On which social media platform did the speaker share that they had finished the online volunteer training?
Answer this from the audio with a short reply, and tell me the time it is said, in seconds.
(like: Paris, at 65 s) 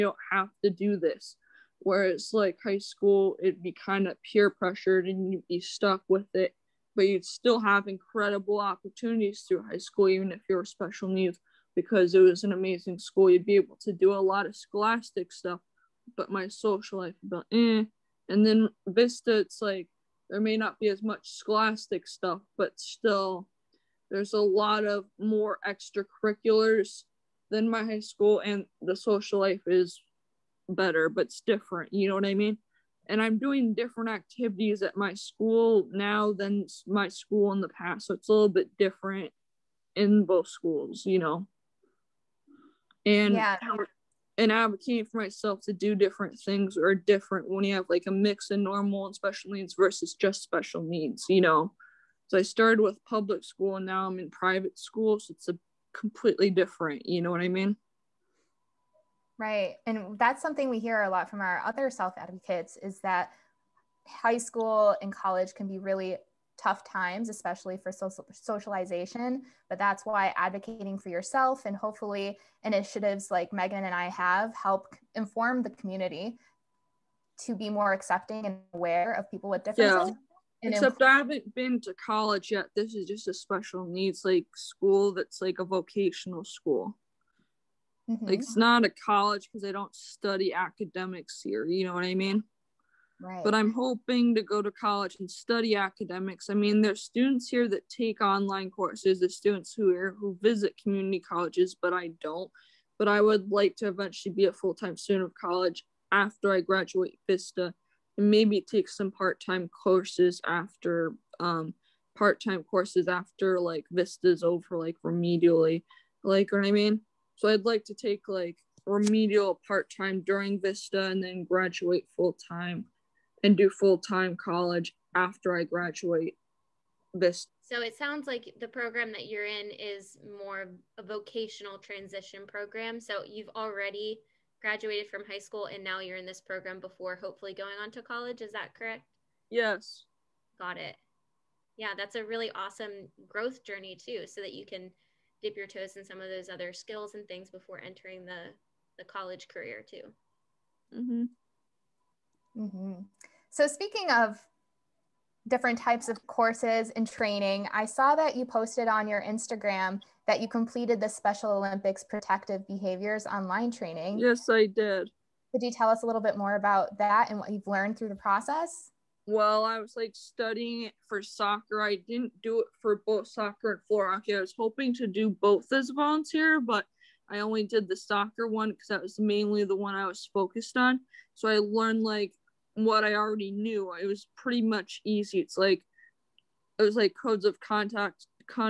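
Instagram, at 159 s.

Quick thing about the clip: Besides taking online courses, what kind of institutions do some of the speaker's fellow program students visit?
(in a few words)
community colleges.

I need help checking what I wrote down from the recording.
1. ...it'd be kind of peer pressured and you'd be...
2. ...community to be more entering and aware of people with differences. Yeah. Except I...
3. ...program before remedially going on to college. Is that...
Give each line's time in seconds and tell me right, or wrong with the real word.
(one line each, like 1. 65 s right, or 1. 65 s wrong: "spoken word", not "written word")
1. 3 s right
2. 75 s wrong: "accepting", not "entering"
3. 136 s wrong: "hopefully", not "remedially".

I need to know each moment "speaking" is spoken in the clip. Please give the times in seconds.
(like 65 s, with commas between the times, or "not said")
153 s.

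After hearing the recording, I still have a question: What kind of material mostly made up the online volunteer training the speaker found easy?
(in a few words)
codes of conduct.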